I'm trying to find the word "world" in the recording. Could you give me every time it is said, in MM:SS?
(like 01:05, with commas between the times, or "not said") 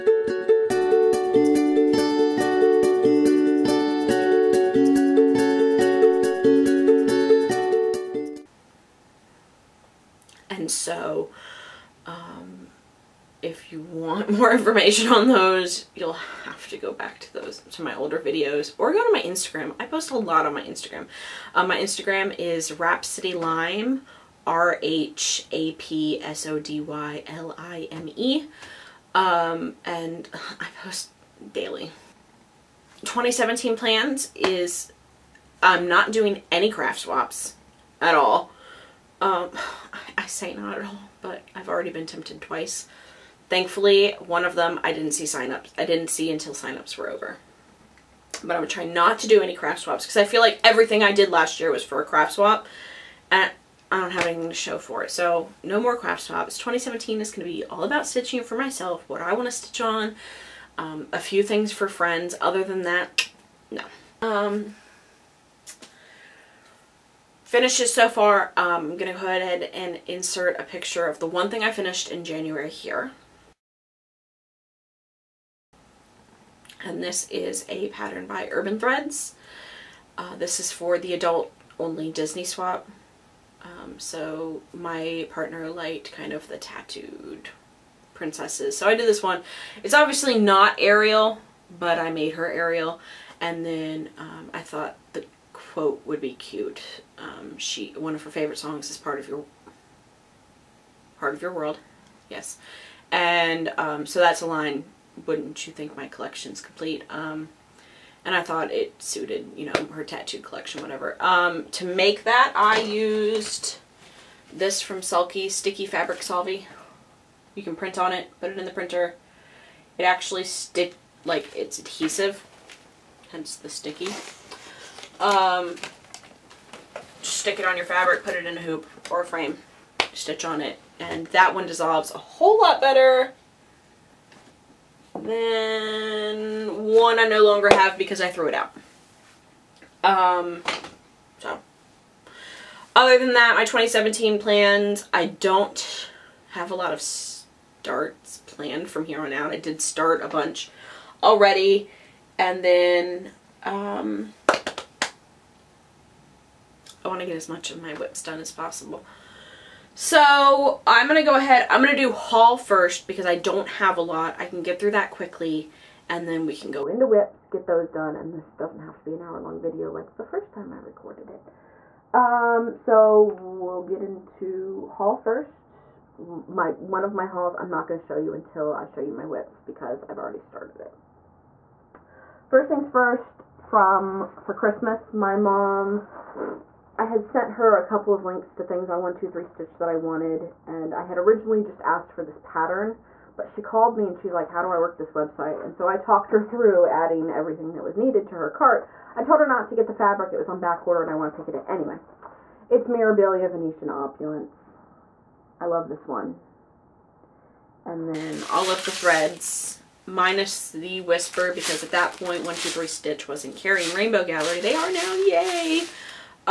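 01:41.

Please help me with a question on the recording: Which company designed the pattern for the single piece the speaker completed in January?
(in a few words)
Urban Threads.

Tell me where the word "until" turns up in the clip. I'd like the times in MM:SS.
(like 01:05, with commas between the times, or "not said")
00:46, 02:58.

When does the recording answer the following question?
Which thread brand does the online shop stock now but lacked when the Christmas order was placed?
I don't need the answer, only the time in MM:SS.
03:33.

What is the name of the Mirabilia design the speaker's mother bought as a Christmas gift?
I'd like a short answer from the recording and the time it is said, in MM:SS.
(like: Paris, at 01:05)
Venetian Opulence, at 03:22.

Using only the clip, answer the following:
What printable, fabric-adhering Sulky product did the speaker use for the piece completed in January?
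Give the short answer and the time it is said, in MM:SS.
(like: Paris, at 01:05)
Sticky Fabric Solvy, at 01:55.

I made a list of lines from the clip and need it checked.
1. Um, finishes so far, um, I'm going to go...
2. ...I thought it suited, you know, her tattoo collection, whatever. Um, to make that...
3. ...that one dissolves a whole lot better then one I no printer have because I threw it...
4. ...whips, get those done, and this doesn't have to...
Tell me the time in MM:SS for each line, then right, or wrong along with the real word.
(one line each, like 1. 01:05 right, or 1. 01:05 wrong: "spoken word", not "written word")
1. 01:04 right
2. 01:48 right
3. 02:11 wrong: "longer", not "printer"
4. 02:47 right.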